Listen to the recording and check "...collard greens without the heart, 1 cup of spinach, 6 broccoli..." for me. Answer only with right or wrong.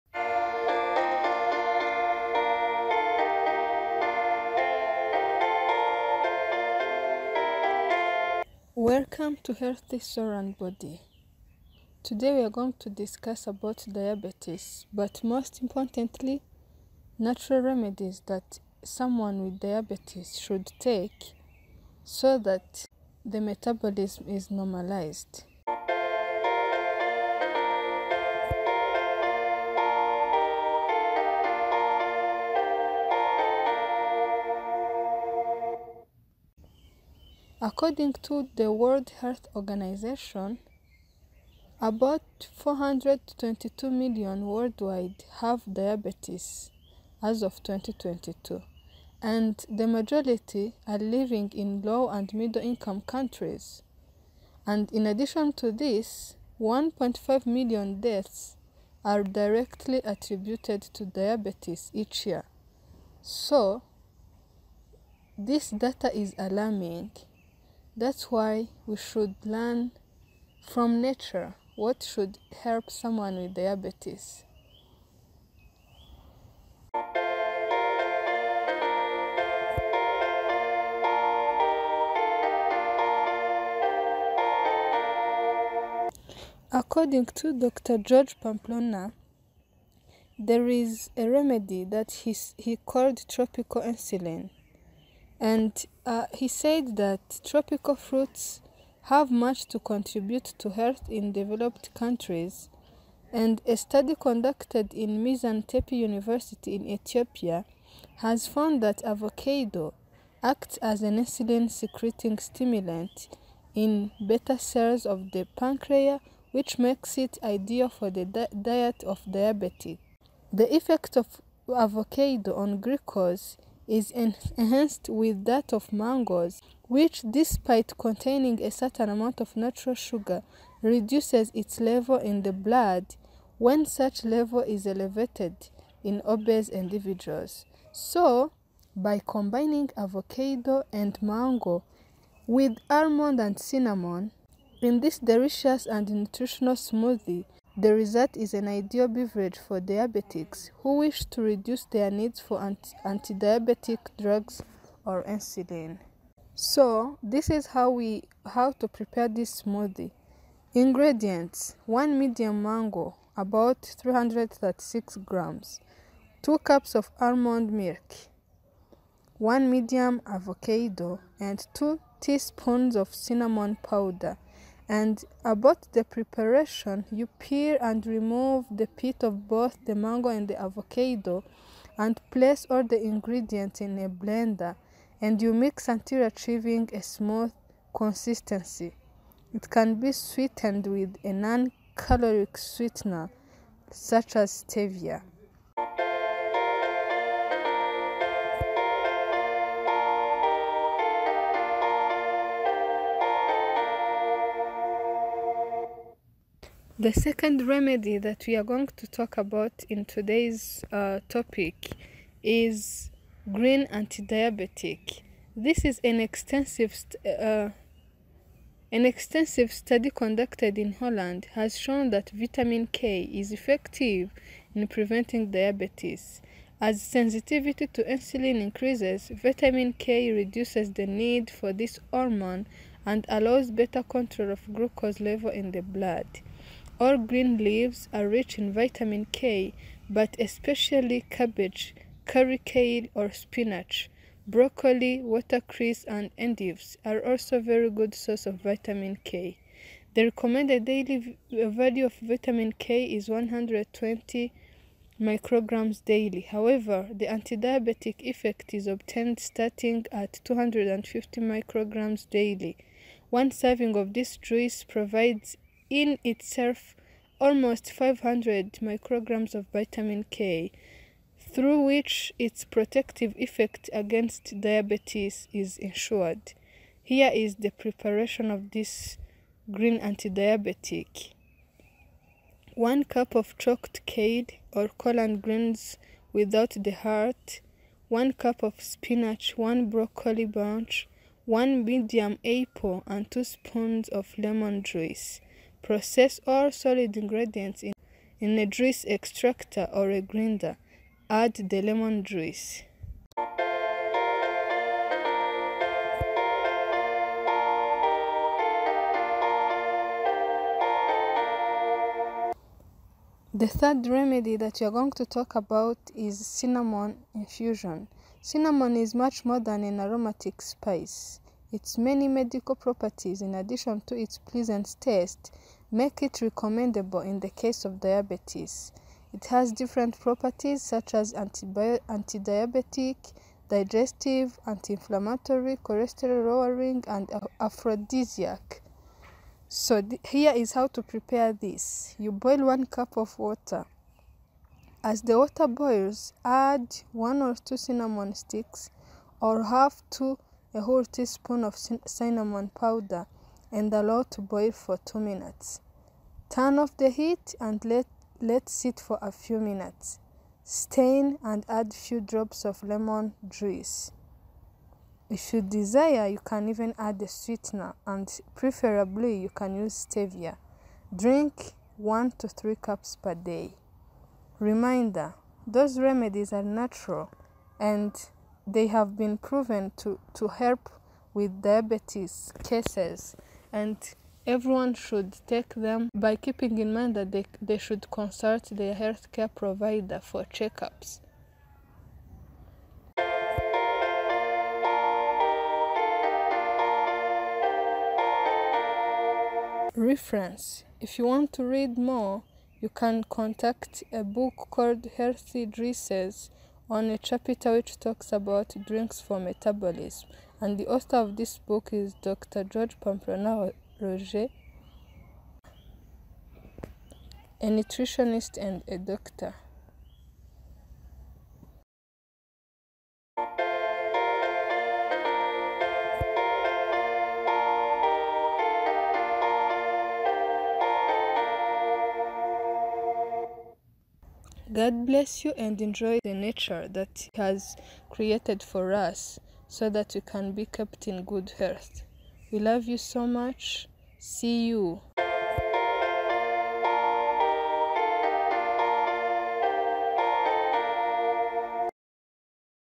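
wrong.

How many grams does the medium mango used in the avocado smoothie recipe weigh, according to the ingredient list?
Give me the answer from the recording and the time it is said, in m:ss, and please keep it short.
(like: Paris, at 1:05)
336 grams, at 2:43.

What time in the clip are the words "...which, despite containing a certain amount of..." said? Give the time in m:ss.
2:06.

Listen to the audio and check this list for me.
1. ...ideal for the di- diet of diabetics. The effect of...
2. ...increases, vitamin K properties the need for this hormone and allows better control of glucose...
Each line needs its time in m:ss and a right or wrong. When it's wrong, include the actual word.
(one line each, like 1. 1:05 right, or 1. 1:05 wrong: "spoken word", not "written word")
1. 1:57 right
2. 3:48 wrong: "reduces", not "properties".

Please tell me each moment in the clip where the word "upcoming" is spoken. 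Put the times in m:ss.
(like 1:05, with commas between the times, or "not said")
not said.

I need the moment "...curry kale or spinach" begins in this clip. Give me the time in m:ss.
4:02.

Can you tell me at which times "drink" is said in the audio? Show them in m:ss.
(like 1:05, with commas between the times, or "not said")
6:11, 6:48.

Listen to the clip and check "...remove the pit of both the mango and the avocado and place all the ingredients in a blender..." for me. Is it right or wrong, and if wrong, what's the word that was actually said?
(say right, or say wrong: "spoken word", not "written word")
right.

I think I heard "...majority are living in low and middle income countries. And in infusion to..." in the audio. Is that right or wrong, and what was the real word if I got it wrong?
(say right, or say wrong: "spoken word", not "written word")
wrong: "addition", not "infusion".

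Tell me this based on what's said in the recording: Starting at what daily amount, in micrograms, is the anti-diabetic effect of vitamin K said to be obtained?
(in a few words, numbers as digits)
250 micrograms.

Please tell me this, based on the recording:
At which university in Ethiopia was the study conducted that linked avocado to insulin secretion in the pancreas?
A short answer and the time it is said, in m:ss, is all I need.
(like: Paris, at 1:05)
Mizan-Tepi University, at 1:45.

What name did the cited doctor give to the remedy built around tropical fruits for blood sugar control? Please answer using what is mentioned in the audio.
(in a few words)
tropical insulin.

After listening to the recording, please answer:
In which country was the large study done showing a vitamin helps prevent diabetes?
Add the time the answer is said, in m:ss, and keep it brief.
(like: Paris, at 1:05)
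Holland, at 3:40.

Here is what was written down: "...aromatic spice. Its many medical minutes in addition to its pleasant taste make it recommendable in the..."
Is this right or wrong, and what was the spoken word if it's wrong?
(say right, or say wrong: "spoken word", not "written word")
wrong: "properties", not "minutes".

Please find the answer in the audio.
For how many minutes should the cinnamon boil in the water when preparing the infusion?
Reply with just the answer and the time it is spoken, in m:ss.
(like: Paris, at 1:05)
2 minutes, at 5:55.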